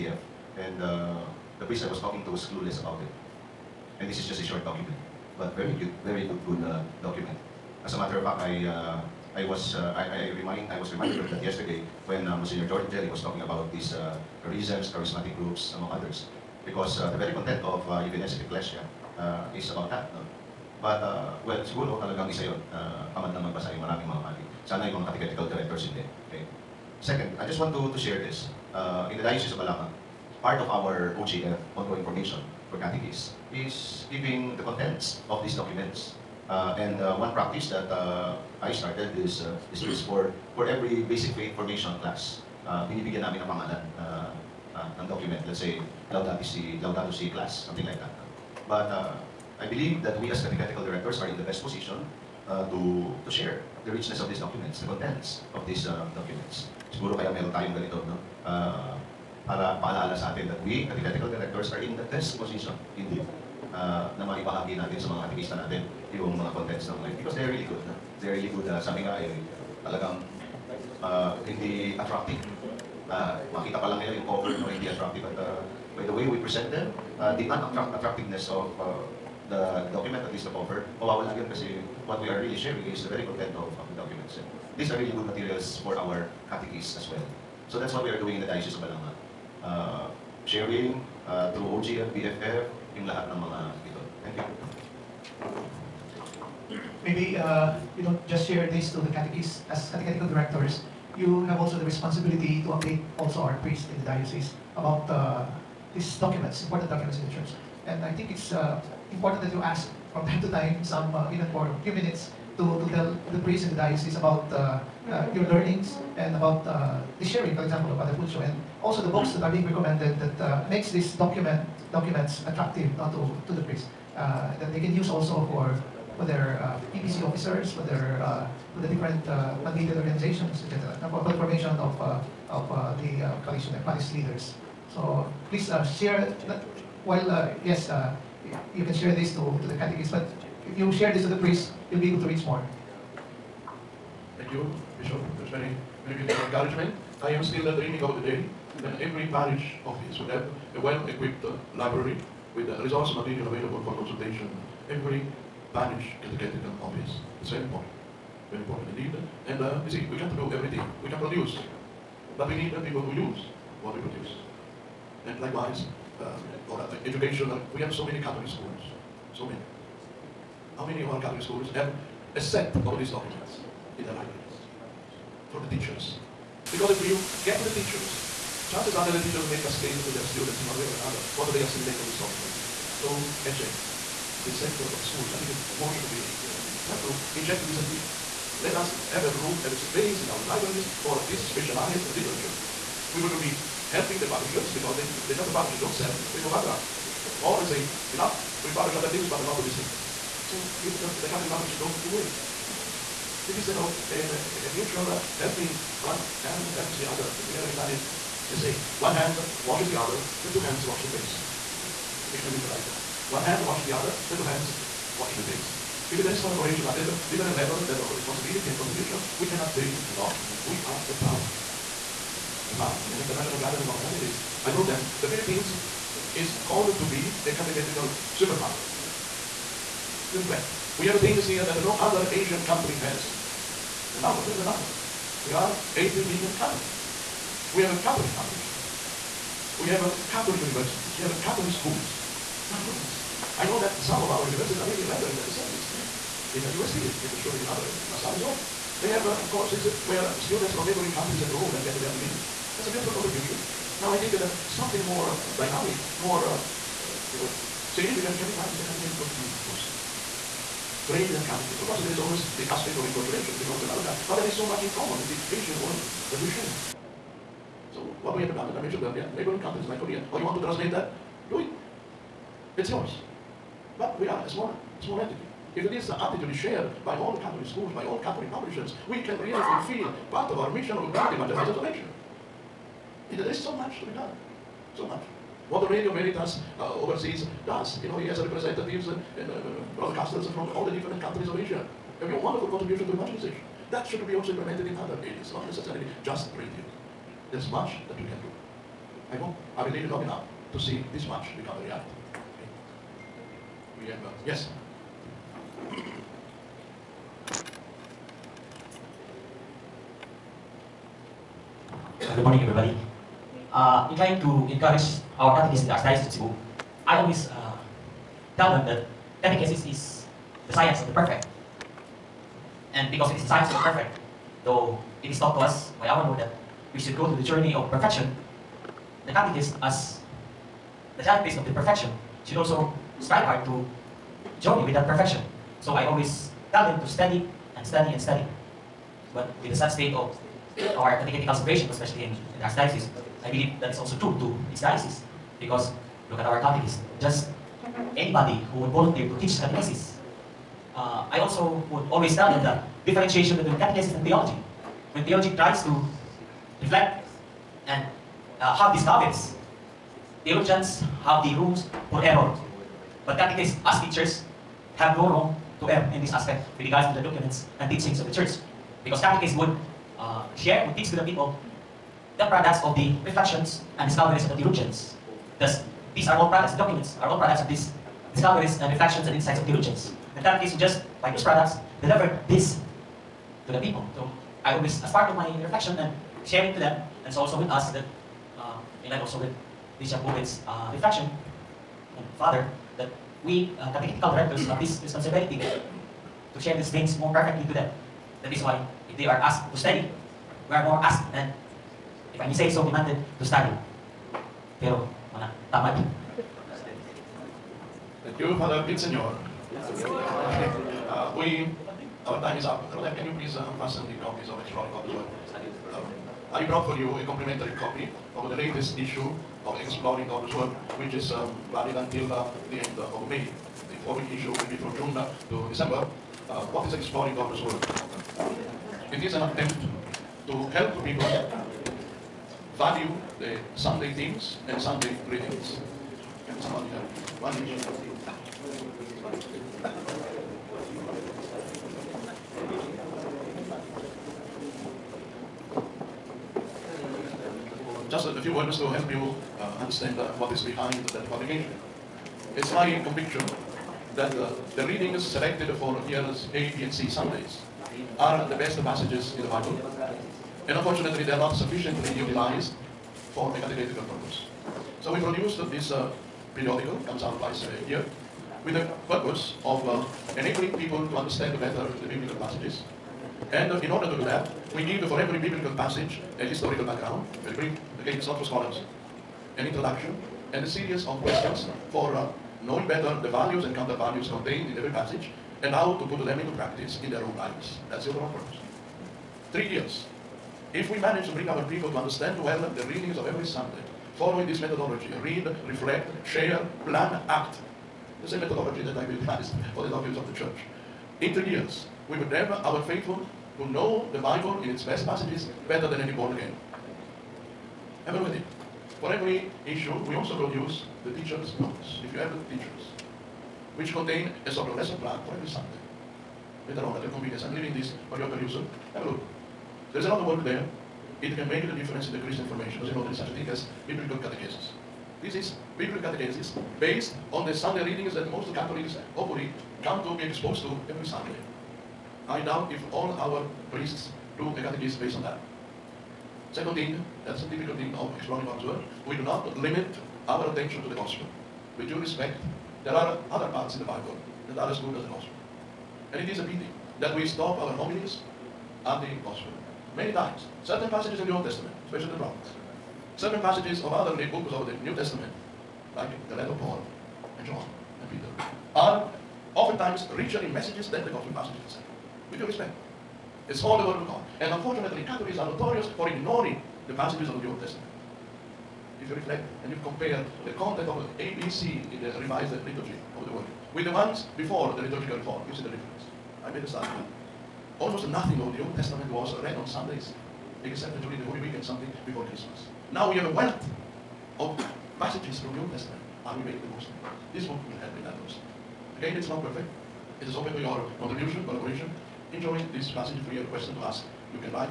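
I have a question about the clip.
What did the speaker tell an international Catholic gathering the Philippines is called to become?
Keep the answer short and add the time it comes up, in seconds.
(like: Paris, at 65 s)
a catechetical superpower, at 227 s.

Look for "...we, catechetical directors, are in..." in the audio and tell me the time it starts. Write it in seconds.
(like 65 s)
60 s.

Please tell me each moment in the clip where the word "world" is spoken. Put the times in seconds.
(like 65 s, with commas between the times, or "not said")
265 s, 573 s.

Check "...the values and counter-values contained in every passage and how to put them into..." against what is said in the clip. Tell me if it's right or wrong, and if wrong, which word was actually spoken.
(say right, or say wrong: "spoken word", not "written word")
right.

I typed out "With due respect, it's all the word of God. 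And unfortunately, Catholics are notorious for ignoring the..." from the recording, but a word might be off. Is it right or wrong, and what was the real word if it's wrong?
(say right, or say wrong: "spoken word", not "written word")
right.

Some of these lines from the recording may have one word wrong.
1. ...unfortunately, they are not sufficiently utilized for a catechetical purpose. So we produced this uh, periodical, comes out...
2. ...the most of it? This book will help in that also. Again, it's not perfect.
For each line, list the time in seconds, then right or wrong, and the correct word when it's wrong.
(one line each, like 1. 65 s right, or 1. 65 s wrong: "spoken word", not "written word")
1. 460 s right
2. 586 s right.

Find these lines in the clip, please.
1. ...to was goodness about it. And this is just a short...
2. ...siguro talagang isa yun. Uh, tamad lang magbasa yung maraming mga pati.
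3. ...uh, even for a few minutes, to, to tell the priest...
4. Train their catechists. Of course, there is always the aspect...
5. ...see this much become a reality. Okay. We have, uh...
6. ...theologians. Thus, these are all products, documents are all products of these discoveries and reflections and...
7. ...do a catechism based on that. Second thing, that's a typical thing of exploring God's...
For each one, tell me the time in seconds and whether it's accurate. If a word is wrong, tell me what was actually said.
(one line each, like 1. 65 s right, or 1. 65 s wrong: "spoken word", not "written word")
1. 2 s wrong: "clueless", not "goodness"
2. 21 s right
3. 111 s right
4. 261 s right
5. 300 s right
6. 374 s right
7. 534 s right.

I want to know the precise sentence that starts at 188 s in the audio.
Let us have a room, have a space in our libraries for this specialized literature.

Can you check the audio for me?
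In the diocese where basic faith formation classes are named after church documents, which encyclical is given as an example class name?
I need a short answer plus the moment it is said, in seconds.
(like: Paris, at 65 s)
Laudato Si, at 46 s.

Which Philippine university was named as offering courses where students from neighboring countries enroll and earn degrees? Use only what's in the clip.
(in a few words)
UST.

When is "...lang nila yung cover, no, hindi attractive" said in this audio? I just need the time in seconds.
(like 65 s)
73 s.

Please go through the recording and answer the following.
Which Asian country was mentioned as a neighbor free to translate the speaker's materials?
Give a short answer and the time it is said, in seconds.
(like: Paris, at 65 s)
Korea, at 269 s.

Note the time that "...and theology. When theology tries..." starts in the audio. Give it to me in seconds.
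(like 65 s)
354 s.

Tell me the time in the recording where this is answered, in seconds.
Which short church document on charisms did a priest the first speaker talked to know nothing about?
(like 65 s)
18 s.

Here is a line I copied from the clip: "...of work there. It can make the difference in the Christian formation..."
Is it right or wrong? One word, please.
right.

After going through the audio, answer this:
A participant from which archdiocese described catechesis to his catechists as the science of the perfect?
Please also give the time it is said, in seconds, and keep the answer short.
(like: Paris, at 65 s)
Cebu, at 315 s.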